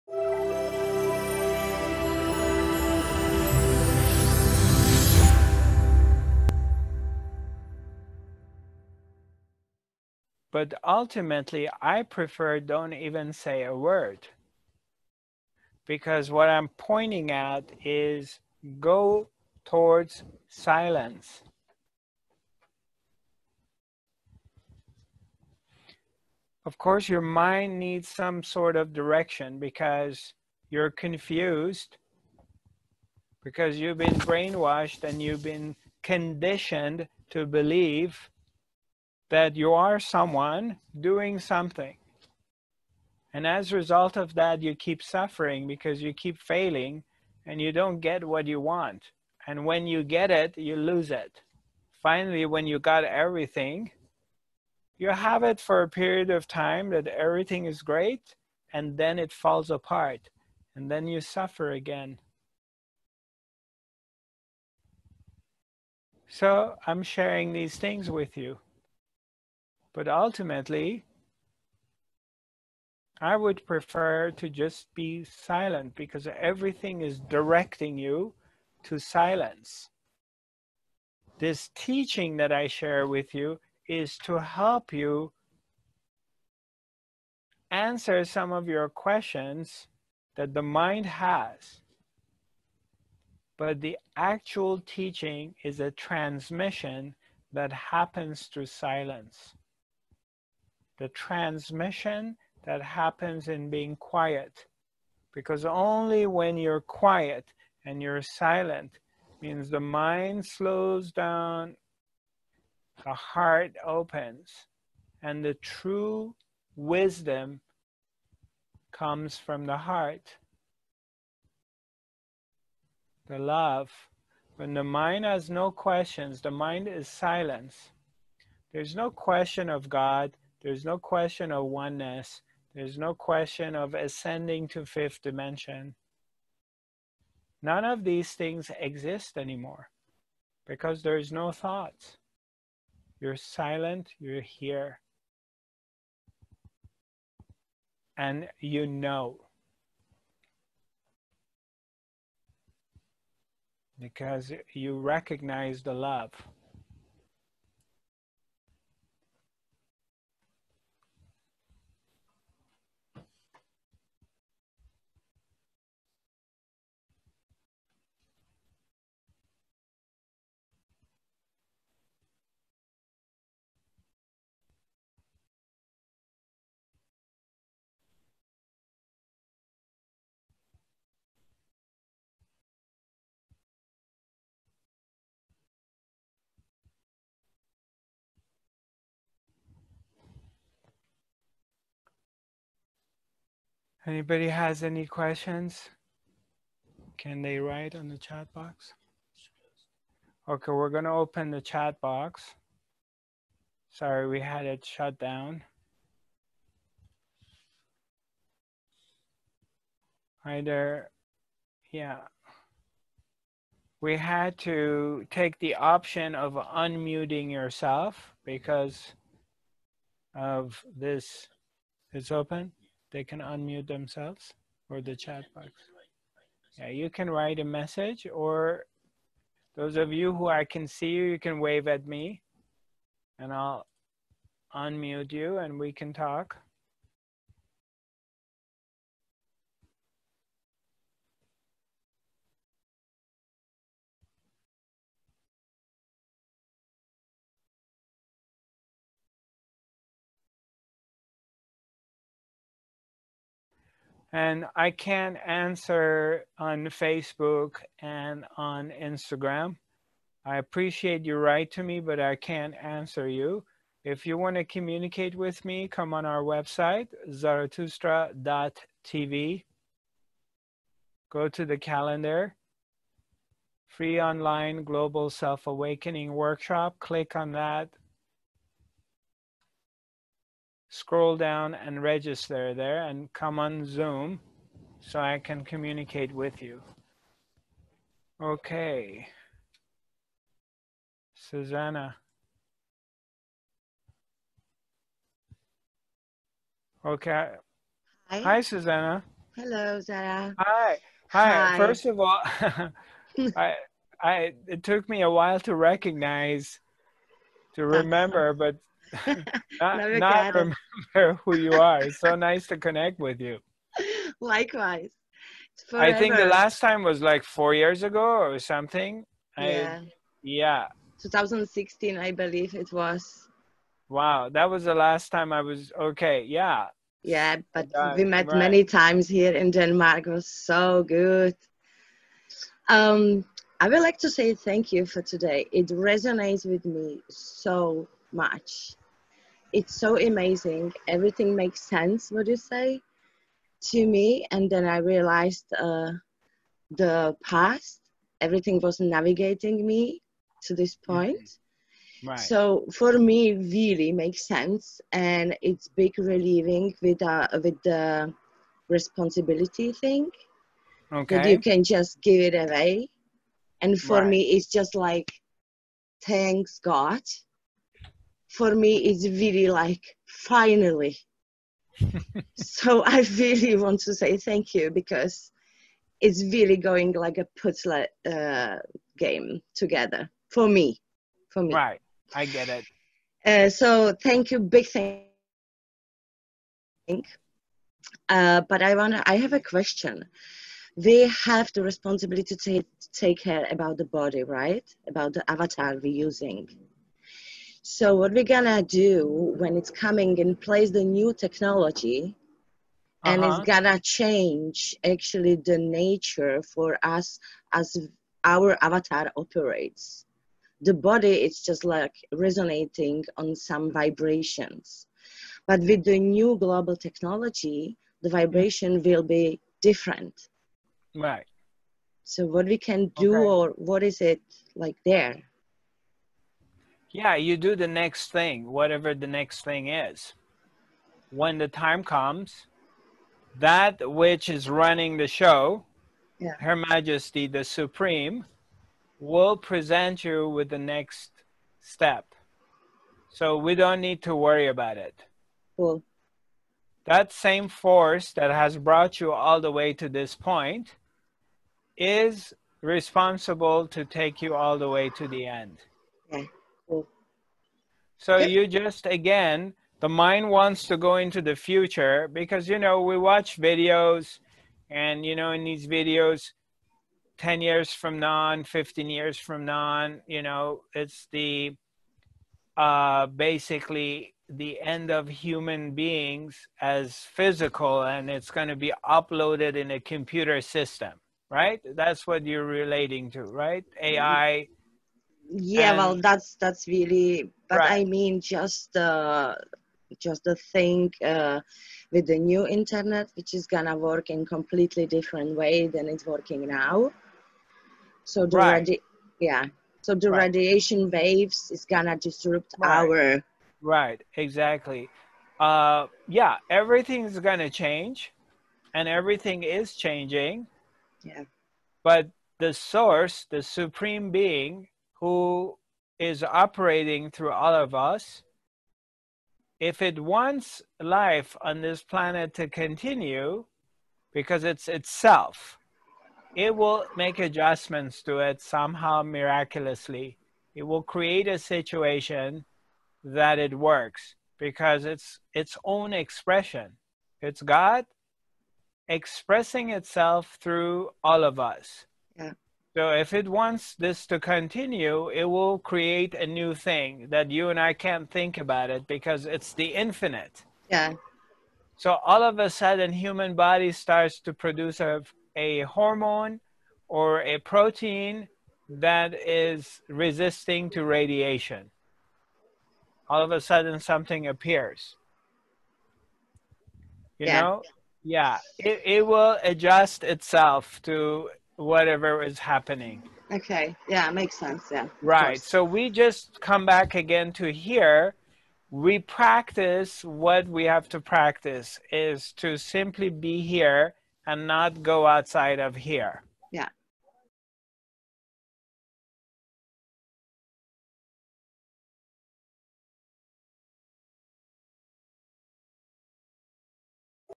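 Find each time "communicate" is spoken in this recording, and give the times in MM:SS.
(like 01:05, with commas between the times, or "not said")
04:24, 04:45.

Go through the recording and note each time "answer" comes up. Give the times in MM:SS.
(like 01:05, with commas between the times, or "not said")
01:27, 04:15, 04:22.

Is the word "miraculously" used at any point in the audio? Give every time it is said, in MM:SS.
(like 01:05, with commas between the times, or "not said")
08:49.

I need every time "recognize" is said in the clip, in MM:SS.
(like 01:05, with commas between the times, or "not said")
02:34, 05:05.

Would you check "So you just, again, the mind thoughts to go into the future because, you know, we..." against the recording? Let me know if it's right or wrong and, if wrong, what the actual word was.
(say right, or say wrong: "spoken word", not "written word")
wrong: "wants", not "thoughts".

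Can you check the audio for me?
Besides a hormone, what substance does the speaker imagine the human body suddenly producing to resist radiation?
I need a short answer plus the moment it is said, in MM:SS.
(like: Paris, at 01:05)
A protein, at 09:17.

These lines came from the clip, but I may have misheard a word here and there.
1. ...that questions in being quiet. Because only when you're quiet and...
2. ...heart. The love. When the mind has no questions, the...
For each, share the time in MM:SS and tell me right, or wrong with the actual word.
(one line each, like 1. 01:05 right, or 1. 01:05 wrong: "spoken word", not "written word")
1. 01:42 wrong: "happens", not "questions"
2. 01:59 right.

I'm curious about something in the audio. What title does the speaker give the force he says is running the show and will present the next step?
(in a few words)
Her Majesty the Supreme.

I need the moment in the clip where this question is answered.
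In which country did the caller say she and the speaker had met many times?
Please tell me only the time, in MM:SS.
05:29.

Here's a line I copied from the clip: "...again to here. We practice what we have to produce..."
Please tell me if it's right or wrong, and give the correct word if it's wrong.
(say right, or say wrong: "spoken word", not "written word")
wrong: "practice", not "produce".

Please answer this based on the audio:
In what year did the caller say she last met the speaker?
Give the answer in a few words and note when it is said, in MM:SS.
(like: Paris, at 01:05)
2016, at 05:21.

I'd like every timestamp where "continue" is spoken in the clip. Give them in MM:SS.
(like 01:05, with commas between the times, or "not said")
08:42, 09:04.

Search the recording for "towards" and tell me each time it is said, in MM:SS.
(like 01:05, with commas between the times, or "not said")
00:19.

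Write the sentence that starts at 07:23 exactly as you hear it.
So we don't need to worry about it.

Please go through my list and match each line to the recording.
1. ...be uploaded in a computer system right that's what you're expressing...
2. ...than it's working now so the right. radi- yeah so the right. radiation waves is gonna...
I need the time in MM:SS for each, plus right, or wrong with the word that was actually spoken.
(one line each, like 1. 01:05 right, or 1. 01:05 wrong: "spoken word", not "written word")
1. 07:58 wrong: "relating", not "expressing"
2. 08:15 right.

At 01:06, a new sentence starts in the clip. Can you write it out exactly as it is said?
So I'm sharing these things with you.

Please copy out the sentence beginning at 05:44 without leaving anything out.
And then I realized uh, the past, everything was navigating me to this mm-hmm.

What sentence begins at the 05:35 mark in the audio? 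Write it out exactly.
It resonates with me so much it's so amazing.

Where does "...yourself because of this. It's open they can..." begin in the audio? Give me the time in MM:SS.
03:37.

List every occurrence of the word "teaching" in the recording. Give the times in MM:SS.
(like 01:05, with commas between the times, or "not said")
01:21, 01:34.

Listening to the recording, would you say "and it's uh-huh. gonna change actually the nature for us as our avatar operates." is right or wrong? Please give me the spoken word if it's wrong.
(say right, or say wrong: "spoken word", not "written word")
right.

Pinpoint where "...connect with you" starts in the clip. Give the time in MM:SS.
05:12.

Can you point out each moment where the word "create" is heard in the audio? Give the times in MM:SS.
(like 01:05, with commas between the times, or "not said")
08:51, 09:05.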